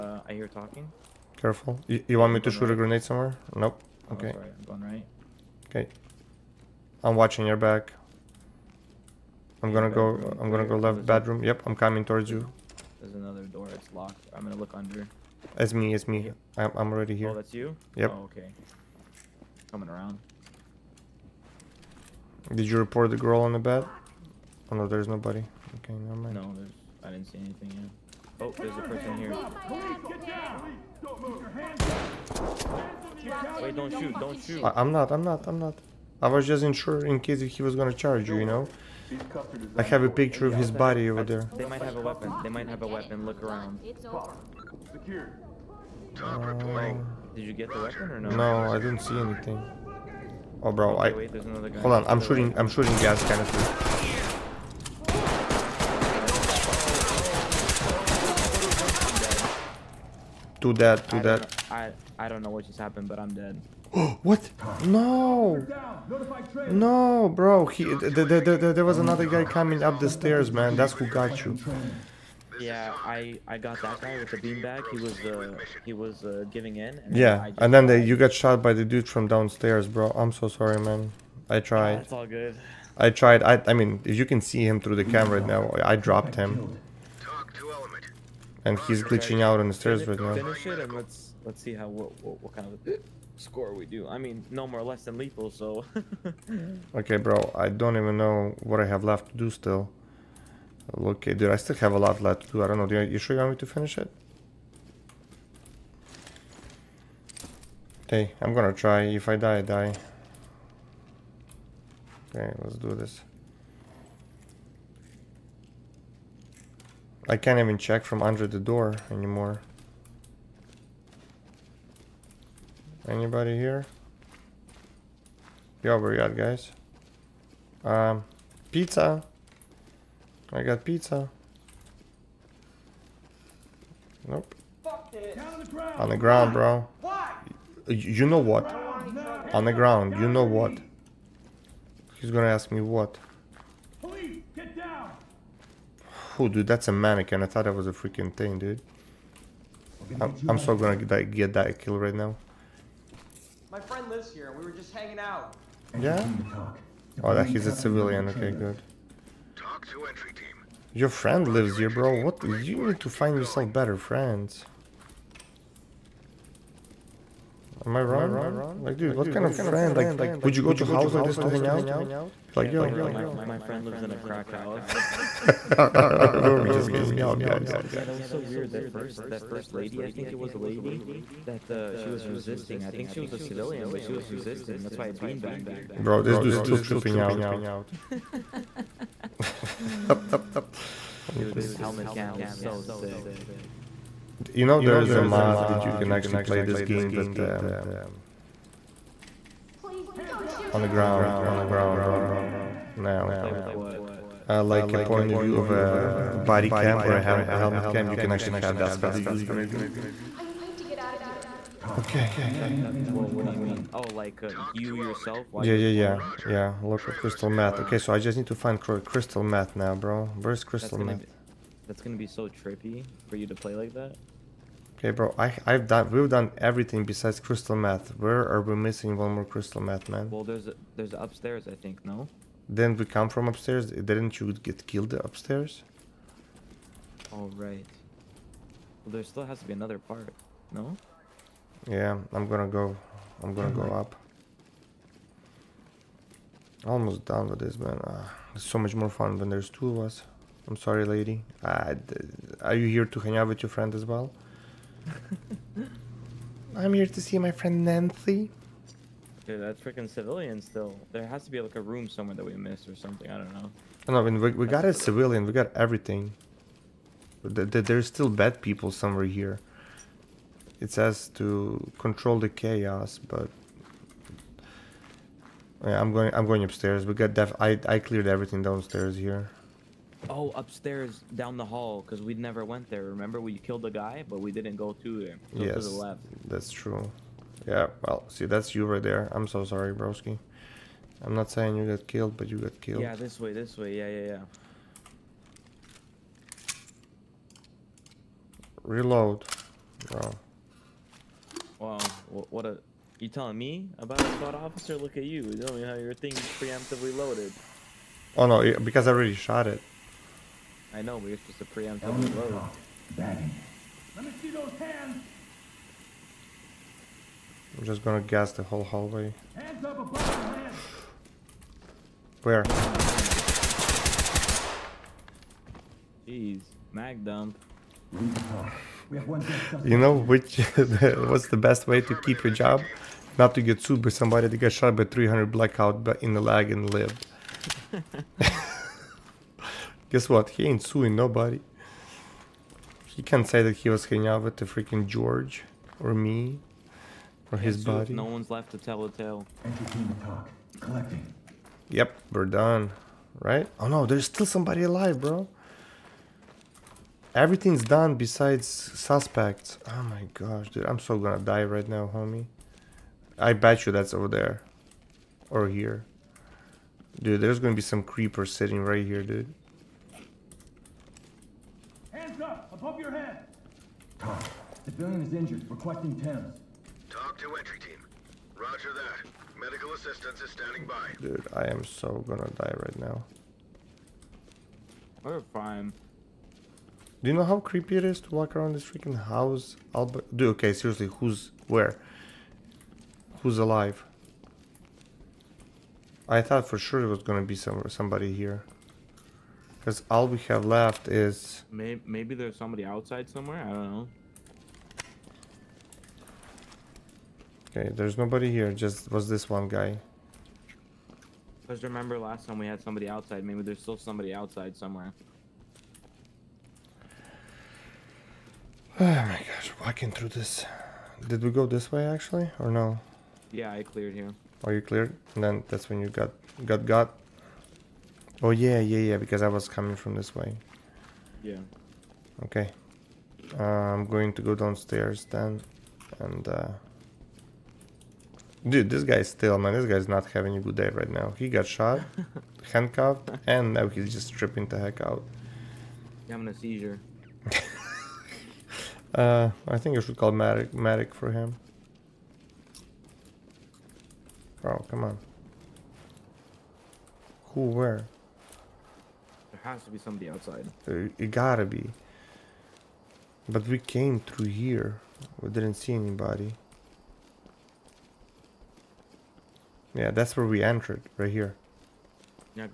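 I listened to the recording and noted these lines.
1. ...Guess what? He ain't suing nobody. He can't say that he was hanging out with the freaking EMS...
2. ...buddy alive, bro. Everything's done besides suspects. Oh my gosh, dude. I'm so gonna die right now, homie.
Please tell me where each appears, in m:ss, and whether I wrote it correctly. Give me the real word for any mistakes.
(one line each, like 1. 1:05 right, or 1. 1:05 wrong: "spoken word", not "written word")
1. 5:40 wrong: "George", not "EMS"
2. 5:54 wrong: "somebody", not "buddy".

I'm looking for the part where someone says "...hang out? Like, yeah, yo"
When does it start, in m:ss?
2:51.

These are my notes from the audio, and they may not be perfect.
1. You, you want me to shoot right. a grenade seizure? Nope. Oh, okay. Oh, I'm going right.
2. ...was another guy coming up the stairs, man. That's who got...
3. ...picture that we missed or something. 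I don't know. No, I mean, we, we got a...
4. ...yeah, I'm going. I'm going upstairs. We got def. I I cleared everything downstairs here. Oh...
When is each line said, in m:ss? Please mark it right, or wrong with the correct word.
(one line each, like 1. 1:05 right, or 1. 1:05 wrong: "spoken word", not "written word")
1. 0:01 wrong: "somewhere", not "seizure"
2. 1:08 right
3. 4:22 wrong: "somewhere", not "picture"
4. 4:35 right.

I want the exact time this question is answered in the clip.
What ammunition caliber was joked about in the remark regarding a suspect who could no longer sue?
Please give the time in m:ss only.
5:35.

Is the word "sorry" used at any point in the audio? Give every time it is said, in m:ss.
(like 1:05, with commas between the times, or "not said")
1:20, 4:10, 4:49.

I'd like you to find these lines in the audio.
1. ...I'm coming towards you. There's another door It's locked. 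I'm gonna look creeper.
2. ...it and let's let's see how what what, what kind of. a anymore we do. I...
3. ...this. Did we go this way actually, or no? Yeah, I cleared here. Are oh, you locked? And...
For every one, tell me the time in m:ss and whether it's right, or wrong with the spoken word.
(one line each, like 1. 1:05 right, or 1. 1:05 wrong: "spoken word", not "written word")
1. 0:11 wrong: "under", not "creeper"
2. 1:30 wrong: "score", not "anymore"
3. 7:00 wrong: "cleared", not "locked".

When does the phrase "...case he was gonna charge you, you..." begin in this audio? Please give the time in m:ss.
0:37.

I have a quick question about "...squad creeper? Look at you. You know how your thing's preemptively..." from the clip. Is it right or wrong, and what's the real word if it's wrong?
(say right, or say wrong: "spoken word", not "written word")
wrong: "officer", not "creeper".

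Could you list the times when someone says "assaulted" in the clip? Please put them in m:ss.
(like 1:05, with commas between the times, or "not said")
not said.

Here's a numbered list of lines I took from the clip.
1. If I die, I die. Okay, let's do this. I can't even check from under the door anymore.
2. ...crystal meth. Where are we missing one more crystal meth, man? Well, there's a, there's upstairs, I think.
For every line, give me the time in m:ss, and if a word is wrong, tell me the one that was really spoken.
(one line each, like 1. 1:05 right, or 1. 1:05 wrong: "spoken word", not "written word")
1. 1:49 right
2. 3:47 right.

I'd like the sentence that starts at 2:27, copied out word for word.
I thought that was a freaking thing, dude.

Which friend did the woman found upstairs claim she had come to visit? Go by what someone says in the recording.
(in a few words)
Nancy.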